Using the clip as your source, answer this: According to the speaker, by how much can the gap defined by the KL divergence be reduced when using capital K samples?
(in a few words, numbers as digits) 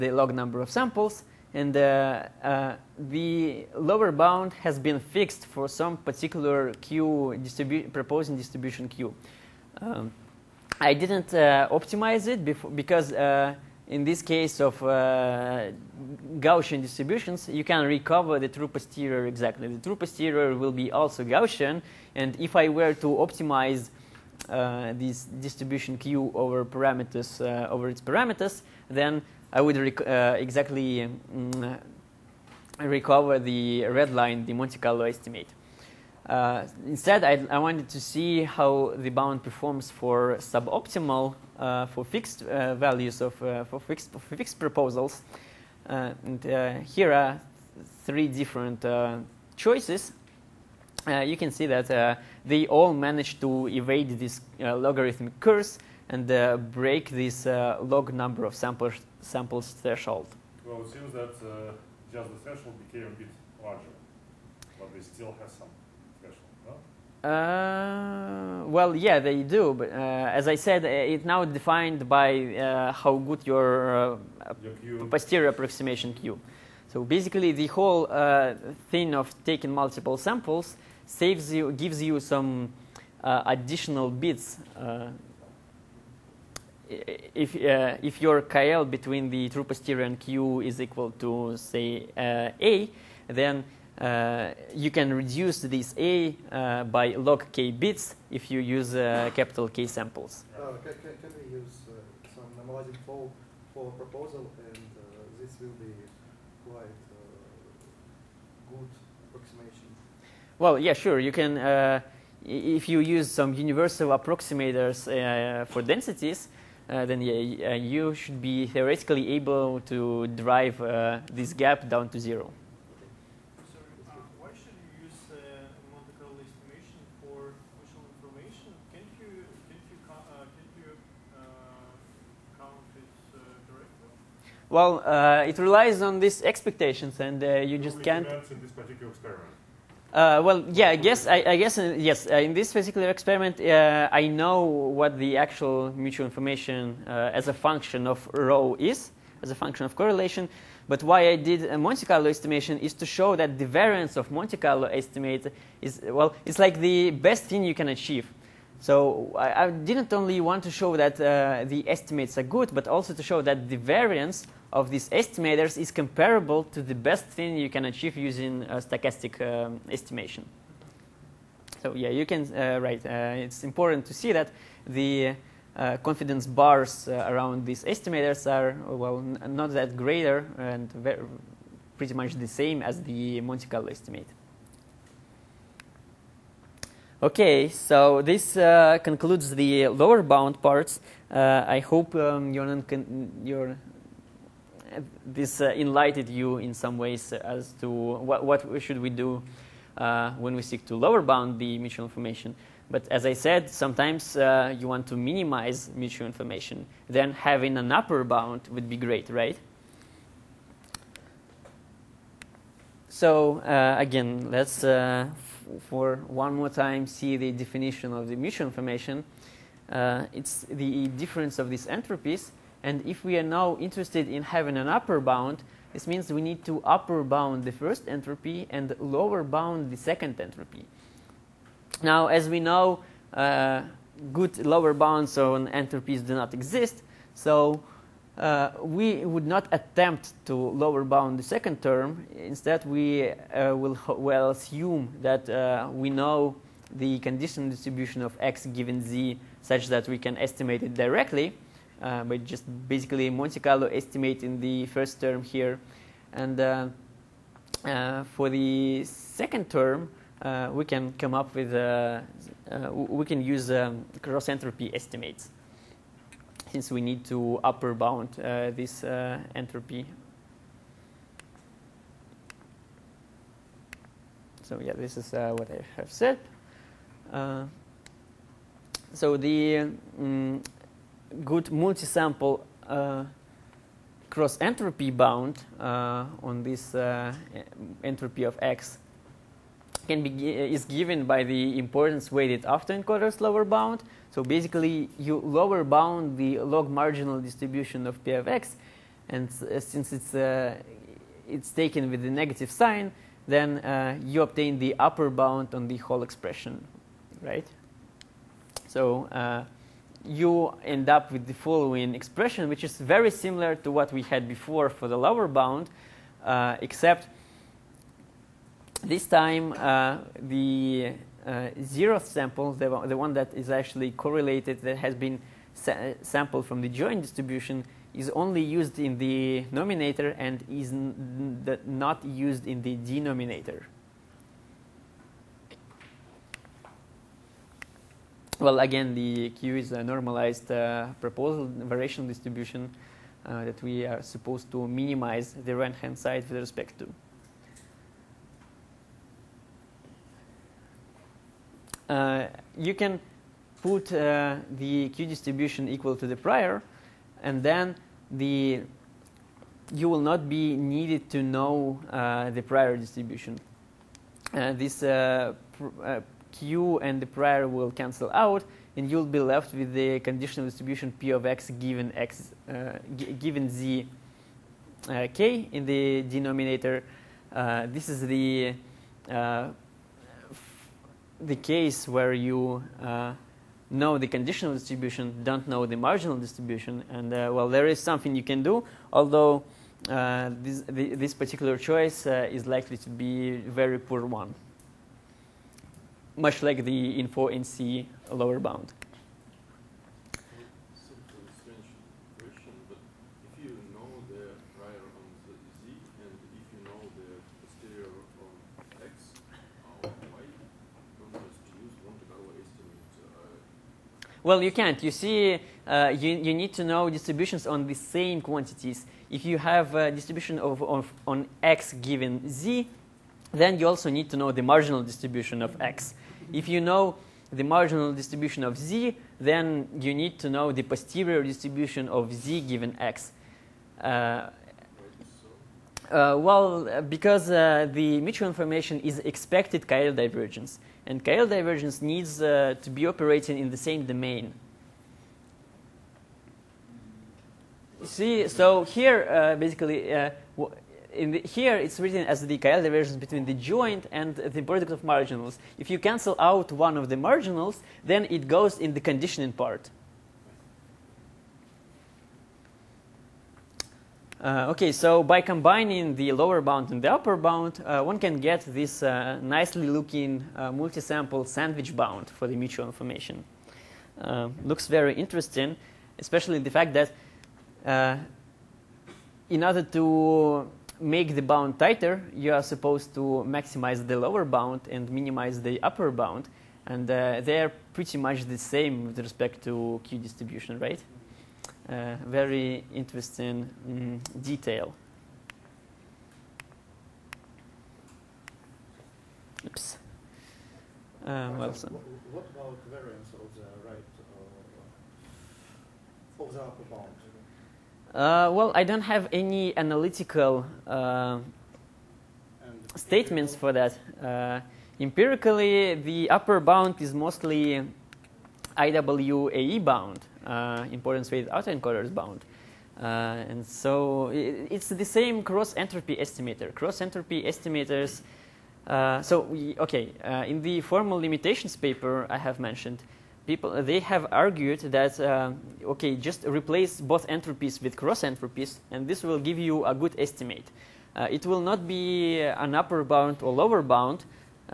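log K bits.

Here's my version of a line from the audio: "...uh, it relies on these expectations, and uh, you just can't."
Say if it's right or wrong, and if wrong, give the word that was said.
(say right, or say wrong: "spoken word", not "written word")
right.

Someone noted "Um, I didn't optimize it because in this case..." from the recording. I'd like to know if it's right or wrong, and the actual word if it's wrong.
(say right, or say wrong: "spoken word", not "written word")
right.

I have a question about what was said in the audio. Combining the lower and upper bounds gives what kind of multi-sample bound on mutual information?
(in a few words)
sandwich bound.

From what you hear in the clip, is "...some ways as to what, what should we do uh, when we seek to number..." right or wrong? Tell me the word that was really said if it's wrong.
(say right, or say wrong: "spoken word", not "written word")
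wrong: "lower", not "number".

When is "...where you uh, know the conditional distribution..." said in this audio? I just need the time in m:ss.
6:22.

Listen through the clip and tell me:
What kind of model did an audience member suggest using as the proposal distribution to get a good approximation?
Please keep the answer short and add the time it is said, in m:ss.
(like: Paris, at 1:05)
normalizing flow, at 1:42.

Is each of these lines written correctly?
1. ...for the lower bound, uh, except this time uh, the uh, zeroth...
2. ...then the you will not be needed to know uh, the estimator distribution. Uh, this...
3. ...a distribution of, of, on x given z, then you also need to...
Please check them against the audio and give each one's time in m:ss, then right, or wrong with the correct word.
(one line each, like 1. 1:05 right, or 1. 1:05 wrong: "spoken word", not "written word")
1. 5:14 right
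2. 5:57 wrong: "prior", not "estimator"
3. 6:59 right.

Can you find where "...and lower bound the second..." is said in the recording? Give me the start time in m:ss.
3:48.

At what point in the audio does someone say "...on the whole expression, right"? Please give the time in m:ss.
5:05.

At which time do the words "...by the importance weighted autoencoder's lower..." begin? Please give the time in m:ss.
4:51.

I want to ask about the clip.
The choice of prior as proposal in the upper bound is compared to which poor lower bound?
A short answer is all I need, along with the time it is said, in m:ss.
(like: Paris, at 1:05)
InfoNCE, at 6:37.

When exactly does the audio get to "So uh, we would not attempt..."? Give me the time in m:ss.
3:57.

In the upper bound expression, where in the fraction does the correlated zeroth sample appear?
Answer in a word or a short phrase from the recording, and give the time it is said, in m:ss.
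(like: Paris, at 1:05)
the numerator, at 5:28.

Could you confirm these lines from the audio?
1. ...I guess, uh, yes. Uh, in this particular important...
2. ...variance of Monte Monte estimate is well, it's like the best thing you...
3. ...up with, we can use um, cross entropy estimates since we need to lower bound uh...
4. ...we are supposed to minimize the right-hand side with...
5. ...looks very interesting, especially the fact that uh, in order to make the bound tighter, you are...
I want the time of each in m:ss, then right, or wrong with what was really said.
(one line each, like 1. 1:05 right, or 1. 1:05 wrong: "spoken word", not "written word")
1. 2:21 wrong: "experiment", not "important"
2. 2:33 wrong: "Carlo", not "Monte"
3. 4:21 wrong: "upper", not "lower"
4. 5:43 right
5. 7:54 right.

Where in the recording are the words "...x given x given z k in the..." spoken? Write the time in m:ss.
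6:11.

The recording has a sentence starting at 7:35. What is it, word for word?
If you cancel out one of the marginals, then it goes in the conditioning part.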